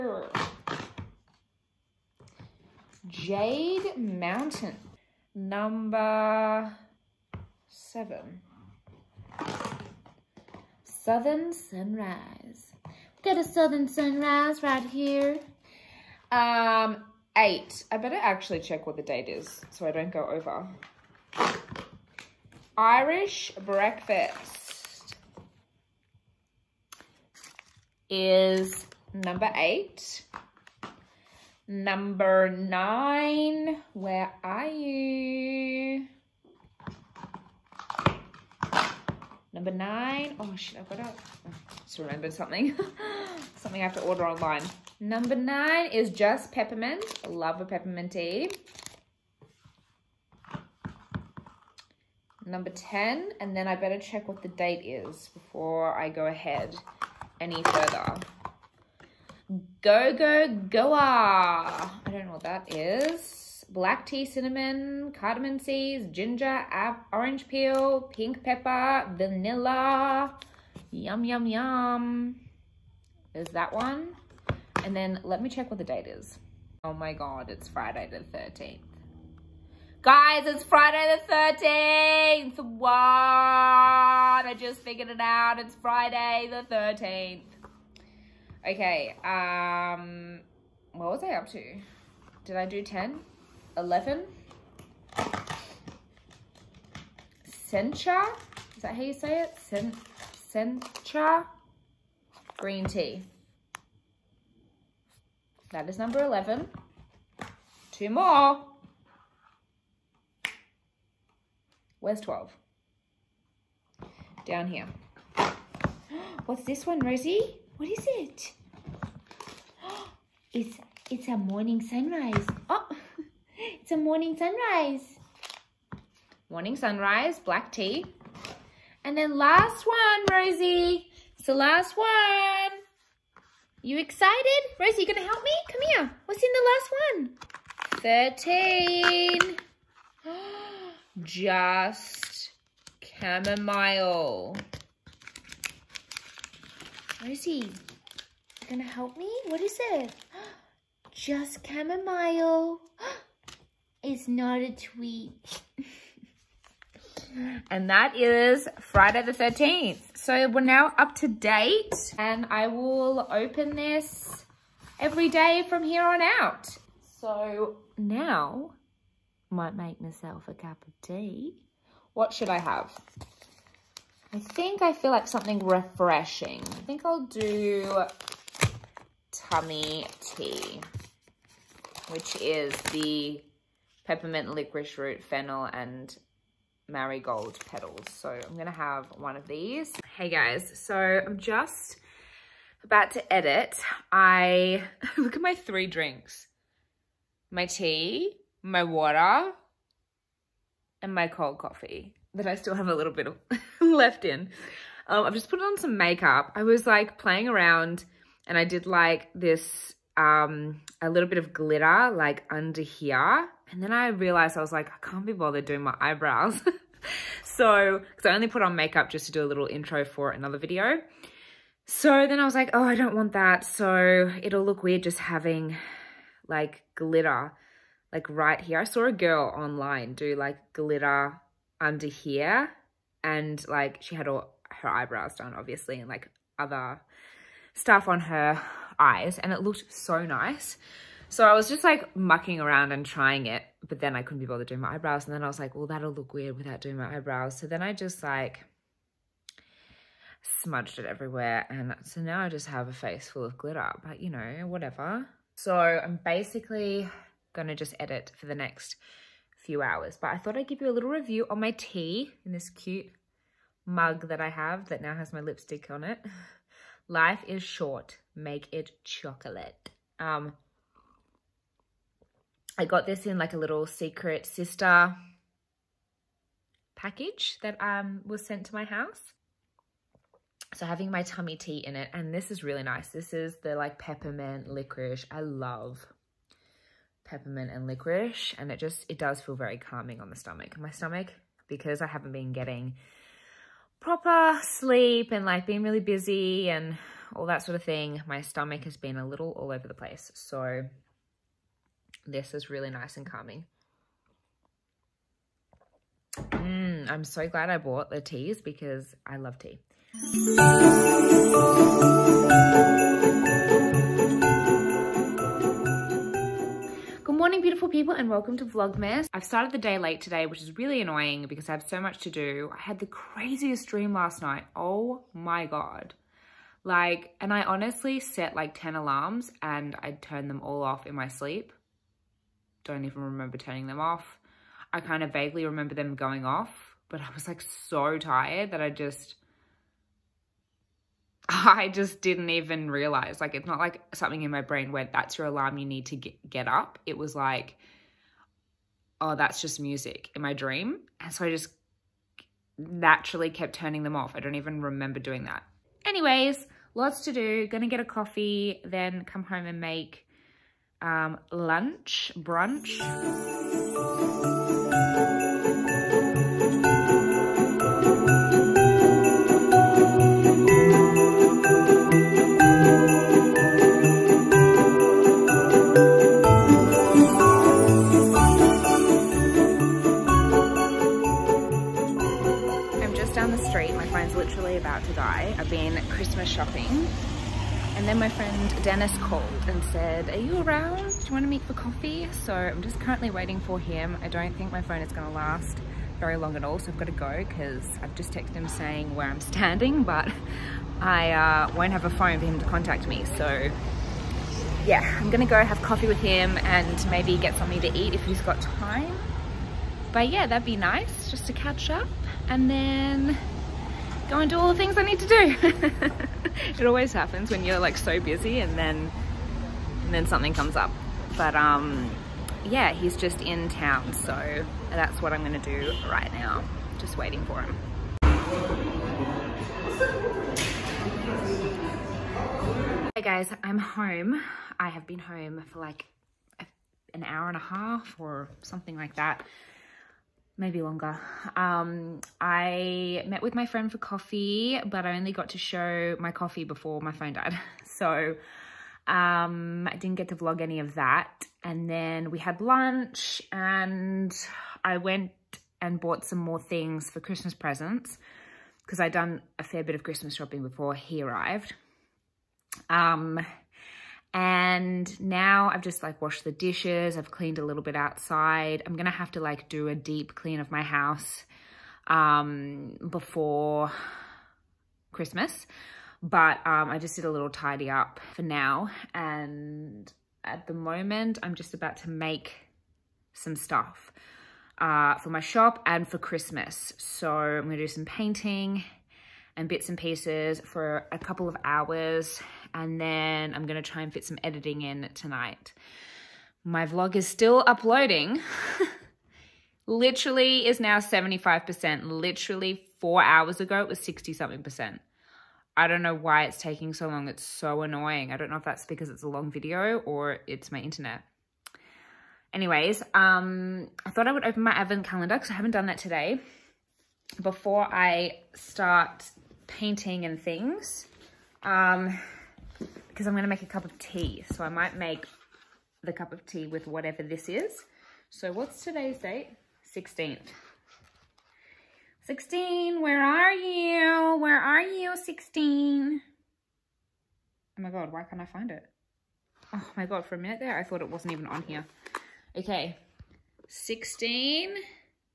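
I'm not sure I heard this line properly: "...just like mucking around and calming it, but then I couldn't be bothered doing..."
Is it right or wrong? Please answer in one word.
wrong.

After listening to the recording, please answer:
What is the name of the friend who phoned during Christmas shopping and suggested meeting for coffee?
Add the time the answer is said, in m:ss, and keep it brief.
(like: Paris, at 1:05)
Dennis, at 6:28.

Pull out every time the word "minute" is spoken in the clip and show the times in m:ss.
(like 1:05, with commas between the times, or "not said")
9:00.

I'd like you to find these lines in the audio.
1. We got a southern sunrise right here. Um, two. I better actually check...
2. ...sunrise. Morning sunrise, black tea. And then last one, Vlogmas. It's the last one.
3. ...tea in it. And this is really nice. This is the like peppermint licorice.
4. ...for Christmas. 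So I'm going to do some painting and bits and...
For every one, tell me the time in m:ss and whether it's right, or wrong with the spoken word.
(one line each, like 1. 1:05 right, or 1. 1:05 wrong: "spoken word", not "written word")
1. 0:12 wrong: "eight", not "two"
2. 2:04 wrong: "Rosie", not "Vlogmas"
3. 4:41 right
4. 8:06 right.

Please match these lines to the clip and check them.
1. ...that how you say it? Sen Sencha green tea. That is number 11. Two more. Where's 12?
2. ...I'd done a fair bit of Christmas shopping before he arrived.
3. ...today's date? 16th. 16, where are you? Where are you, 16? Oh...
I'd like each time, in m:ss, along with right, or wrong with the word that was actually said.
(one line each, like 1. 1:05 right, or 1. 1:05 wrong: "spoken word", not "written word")
1. 1:38 right
2. 7:39 right
3. 8:48 right.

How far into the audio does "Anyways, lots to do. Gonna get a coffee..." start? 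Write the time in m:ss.
5:56.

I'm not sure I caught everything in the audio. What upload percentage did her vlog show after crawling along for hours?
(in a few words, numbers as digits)
75%.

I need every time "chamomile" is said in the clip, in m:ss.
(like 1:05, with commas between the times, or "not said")
2:23, 2:31.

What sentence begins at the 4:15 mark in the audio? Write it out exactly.
So I'm basically gonna just edit for the next few hours.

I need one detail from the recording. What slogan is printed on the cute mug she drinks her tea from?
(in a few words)
Life is short. Make it chocolate.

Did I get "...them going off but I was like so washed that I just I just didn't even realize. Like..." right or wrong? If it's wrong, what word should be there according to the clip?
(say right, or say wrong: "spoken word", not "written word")
wrong: "tired", not "washed".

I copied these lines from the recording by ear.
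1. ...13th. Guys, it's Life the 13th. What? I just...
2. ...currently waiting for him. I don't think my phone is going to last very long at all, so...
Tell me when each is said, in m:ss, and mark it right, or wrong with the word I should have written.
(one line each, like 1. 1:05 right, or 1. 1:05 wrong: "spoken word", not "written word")
1. 1:18 wrong: "Friday", not "Life"
2. 6:33 right.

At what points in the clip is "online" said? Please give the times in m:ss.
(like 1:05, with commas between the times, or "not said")
0:44, 3:49.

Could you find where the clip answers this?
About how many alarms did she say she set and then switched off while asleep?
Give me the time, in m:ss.
5:28.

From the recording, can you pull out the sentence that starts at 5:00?
So this is really nice and calming.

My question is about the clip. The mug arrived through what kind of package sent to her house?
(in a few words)
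Secret sister package.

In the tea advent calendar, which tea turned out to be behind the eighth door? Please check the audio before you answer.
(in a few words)
Irish breakfast.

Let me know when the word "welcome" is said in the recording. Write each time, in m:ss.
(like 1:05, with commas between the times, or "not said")
5:18.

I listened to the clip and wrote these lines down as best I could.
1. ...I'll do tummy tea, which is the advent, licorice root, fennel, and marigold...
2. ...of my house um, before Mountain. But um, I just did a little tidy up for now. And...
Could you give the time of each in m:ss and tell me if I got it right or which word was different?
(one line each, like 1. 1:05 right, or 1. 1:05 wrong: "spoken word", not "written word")
1. 2:57 wrong: "peppermint", not "advent"
2. 7:50 wrong: "Christmas", not "Mountain".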